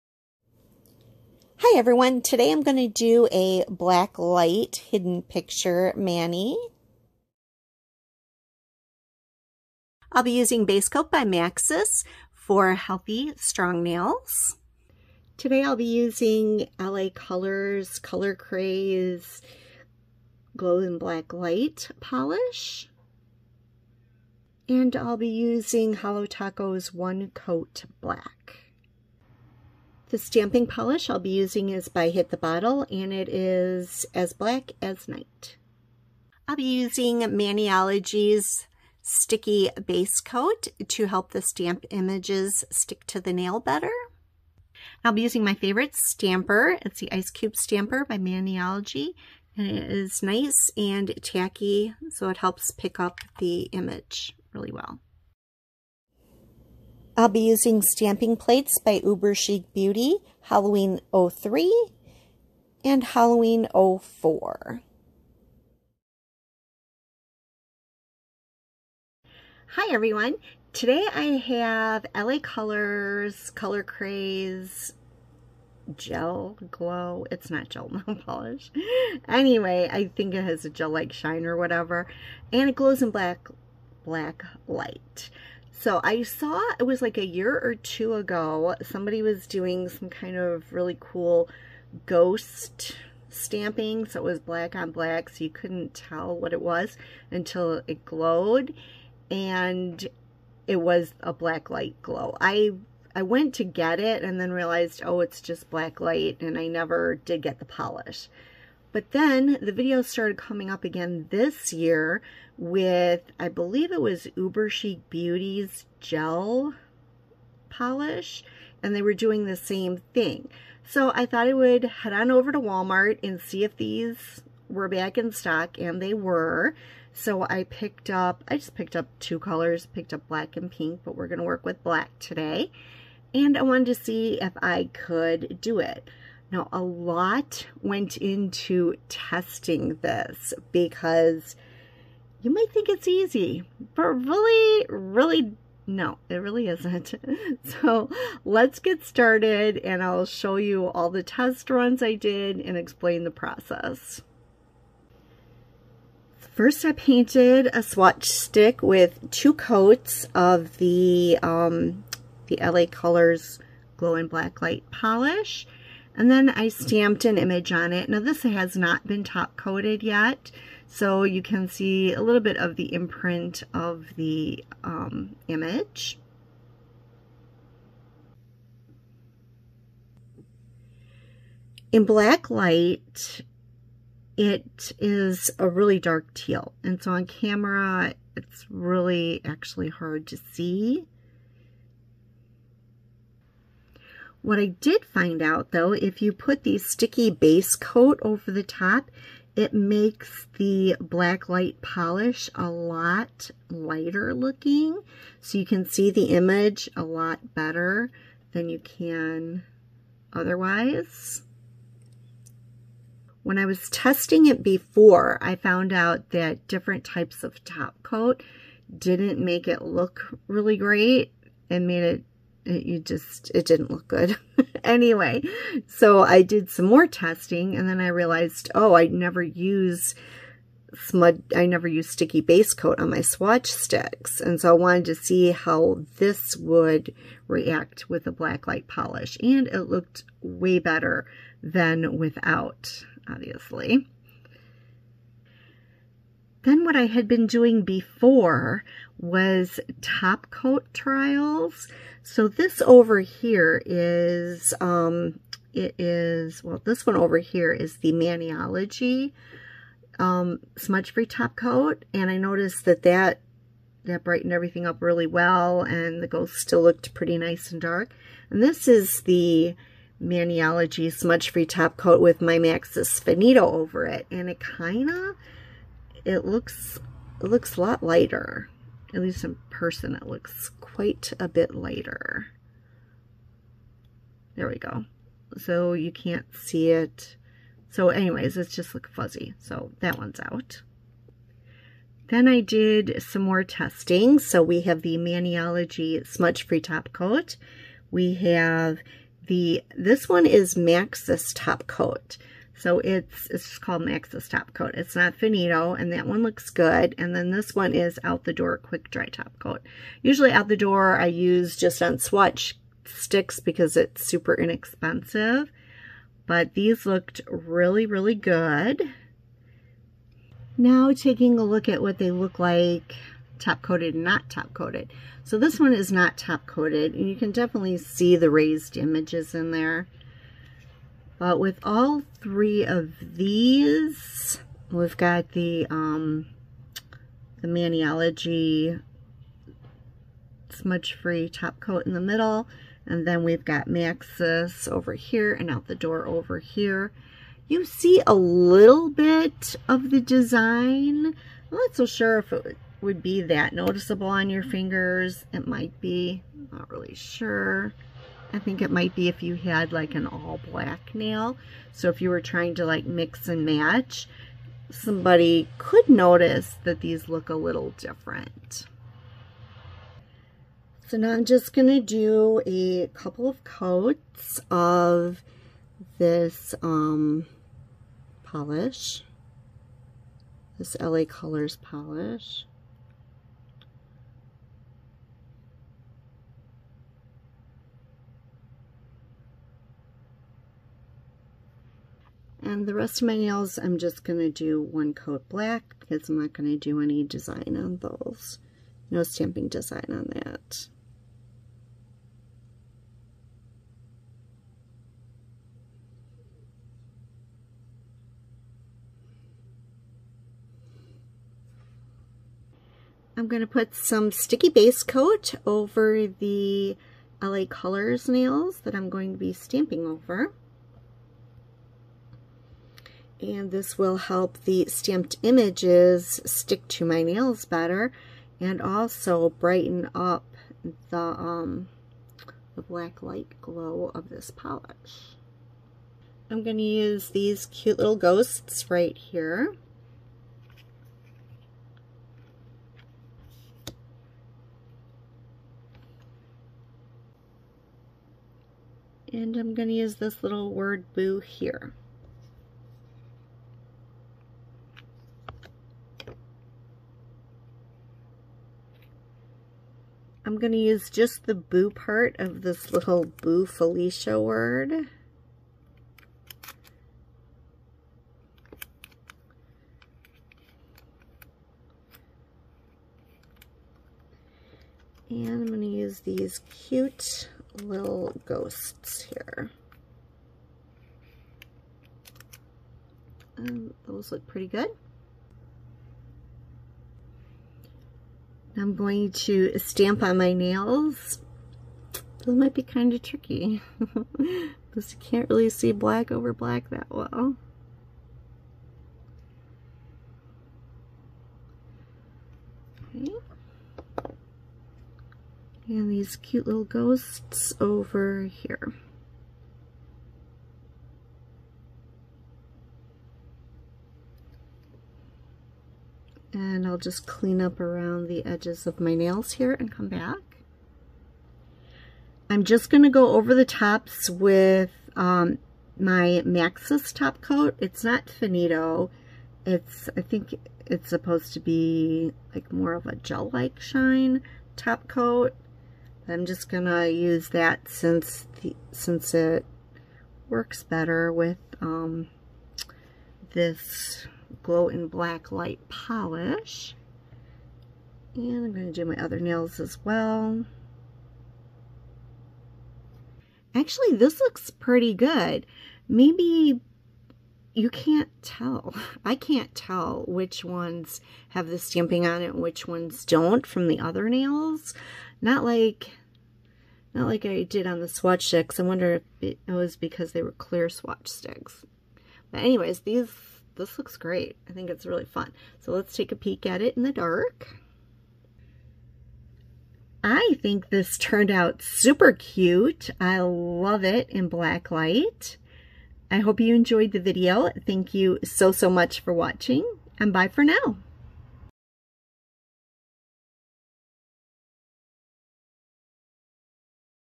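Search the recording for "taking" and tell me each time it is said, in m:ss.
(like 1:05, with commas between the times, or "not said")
5:21.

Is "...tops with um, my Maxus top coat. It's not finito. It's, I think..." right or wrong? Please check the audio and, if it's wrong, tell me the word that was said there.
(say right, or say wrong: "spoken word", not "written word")
right.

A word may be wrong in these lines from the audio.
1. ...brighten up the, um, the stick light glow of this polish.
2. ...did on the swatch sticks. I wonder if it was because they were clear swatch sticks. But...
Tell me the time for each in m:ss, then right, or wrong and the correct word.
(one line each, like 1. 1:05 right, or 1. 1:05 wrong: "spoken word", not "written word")
1. 7:09 wrong: "black", not "stick"
2. 9:27 right.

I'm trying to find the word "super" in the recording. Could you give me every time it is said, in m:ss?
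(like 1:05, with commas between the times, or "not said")
5:14, 9:41.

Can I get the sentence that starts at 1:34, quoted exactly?
So it was black on black, so you couldn't tell what it was until it glowed.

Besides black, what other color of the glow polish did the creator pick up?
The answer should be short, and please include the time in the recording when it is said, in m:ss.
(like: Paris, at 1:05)
pink, at 2:10.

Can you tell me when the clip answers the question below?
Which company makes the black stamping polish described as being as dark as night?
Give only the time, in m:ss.
0:32.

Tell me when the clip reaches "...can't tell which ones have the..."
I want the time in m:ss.
9:19.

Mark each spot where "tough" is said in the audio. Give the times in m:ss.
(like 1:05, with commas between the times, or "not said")
not said.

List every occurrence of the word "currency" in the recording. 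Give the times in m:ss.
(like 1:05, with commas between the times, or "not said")
not said.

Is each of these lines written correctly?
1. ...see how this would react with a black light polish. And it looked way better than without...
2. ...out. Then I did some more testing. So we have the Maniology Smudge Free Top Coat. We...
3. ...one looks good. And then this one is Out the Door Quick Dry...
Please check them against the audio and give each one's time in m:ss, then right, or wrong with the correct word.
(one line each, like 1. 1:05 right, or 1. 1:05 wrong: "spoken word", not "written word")
1. 3:55 right
2. 4:50 right
3. 5:06 right.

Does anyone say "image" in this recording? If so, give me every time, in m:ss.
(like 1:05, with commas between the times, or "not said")
0:41, 0:53, 2:47, 2:55, 3:26, 5:28, 7:05.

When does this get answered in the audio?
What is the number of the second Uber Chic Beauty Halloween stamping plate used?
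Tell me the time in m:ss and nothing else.
1:03.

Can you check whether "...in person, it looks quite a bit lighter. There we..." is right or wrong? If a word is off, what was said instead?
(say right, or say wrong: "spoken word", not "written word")
right.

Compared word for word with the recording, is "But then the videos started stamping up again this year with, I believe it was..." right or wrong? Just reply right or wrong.
wrong.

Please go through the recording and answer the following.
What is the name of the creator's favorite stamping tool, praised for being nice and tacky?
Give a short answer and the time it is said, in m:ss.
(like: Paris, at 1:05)
Ice Cube Stamper, at 0:47.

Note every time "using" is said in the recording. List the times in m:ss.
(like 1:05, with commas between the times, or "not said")
0:10, 0:15, 0:25, 0:31, 0:36, 0:45, 0:57.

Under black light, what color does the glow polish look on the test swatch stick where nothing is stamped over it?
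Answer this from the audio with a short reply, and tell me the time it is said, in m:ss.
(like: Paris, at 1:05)
dark teal, at 3:05.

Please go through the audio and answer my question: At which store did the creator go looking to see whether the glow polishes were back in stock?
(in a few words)
Walmart.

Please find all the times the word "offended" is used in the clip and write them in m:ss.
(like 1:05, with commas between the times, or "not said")
not said.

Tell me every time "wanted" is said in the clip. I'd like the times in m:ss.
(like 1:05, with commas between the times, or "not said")
2:13, 3:54.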